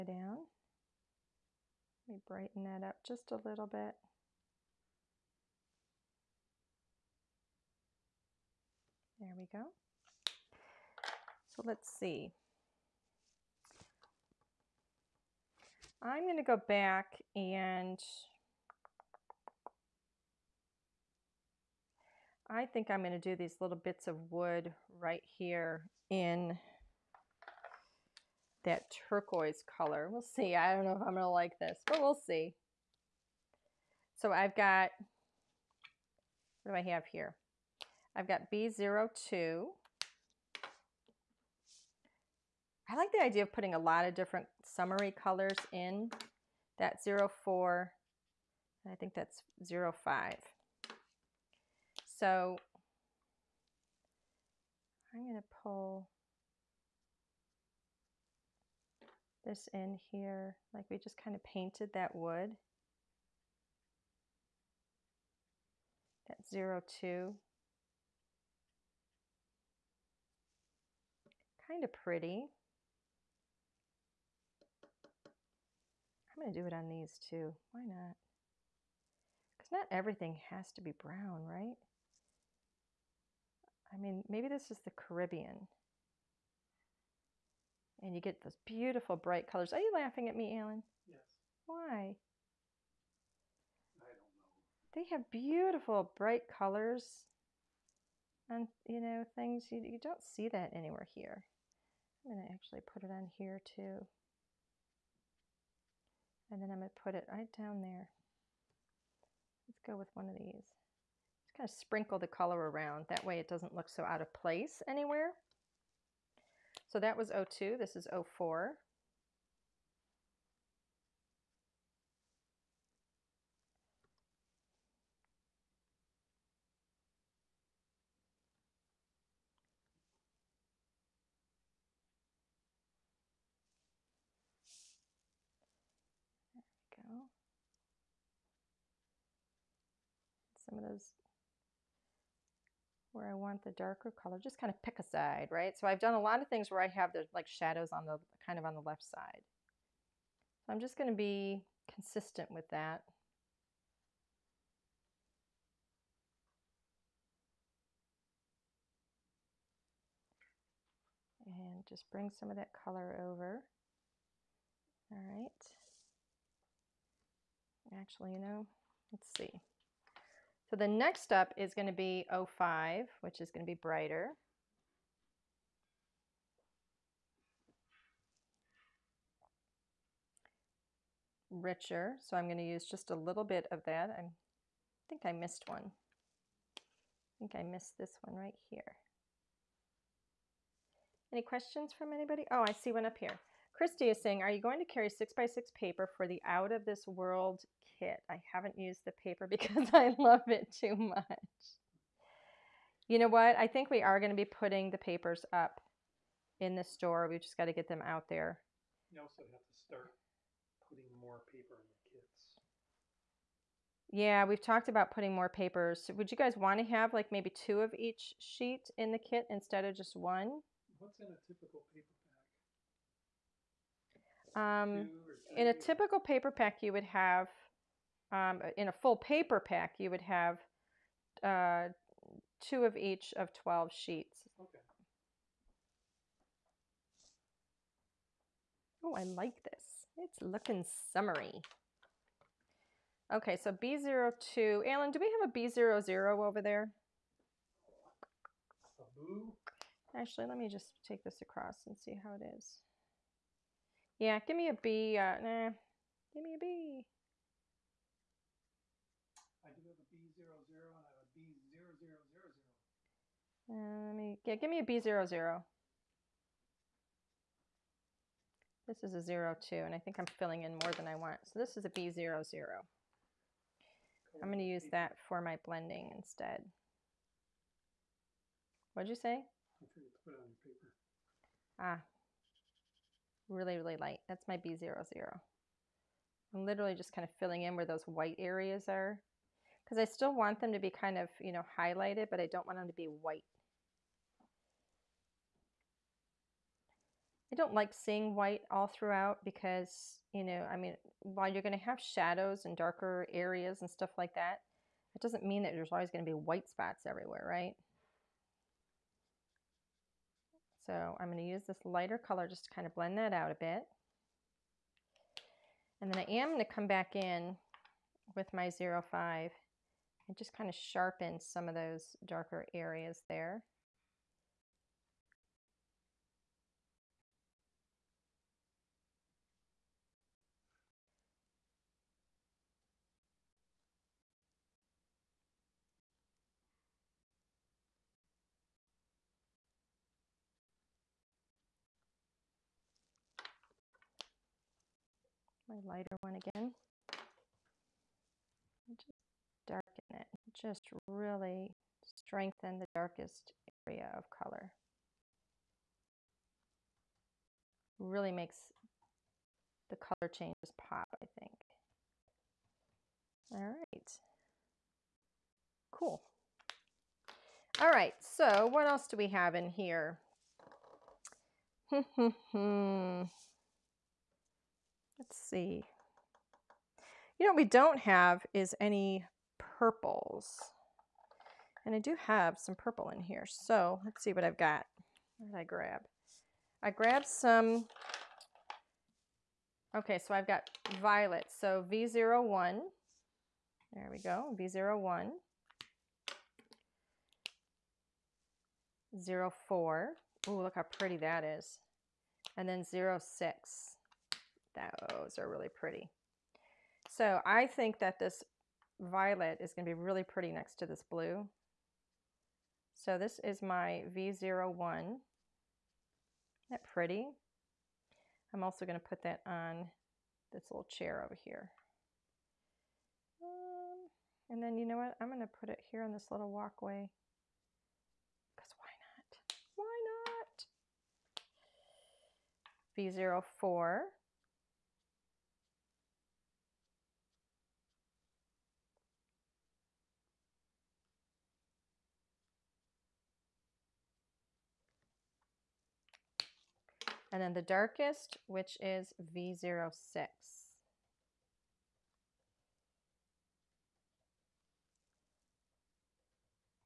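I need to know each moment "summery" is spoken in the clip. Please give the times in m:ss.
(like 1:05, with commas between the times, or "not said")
0:44, 4:01.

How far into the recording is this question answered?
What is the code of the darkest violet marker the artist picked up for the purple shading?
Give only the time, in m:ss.
7:29.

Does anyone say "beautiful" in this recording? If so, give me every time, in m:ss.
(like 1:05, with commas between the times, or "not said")
1:28, 1:35.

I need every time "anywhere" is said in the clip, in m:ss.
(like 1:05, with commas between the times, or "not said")
1:40, 1:54.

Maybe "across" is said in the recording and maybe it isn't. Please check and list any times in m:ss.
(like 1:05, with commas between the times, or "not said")
4:11.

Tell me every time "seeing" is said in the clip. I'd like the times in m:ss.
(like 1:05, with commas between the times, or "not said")
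4:57.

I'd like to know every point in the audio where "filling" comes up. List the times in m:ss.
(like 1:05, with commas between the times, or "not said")
4:30, 4:47.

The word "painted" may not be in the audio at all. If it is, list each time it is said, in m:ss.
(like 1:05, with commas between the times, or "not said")
1:01.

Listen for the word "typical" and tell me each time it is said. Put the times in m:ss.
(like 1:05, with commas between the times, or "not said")
3:41, 3:45.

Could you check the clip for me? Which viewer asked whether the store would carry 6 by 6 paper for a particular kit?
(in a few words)
Christy.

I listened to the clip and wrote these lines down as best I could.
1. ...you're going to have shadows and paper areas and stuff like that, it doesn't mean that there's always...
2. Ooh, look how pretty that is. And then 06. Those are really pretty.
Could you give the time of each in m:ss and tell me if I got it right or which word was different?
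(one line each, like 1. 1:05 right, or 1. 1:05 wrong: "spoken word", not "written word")
1. 5:01 wrong: "darker", not "paper"
2. 6:40 right.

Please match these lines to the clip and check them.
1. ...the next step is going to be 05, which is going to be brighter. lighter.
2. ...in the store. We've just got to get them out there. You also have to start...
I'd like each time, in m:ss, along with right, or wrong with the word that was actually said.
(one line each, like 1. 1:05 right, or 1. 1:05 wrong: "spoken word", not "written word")
1. 2:50 wrong: "richer", not "lighter"
2. 3:26 right.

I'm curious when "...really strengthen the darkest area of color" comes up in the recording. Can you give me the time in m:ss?
5:50.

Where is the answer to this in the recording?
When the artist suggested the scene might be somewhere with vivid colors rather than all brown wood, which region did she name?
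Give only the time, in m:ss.
1:24.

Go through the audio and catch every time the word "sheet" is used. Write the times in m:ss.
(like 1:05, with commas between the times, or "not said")
3:38, 3:53.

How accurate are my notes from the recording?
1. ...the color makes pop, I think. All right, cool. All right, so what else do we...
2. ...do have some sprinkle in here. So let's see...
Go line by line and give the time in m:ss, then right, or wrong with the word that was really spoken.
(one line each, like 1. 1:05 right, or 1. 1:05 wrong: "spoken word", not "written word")
1. 5:59 wrong: "changes", not "makes"
2. 6:21 wrong: "purple", not "sprinkle".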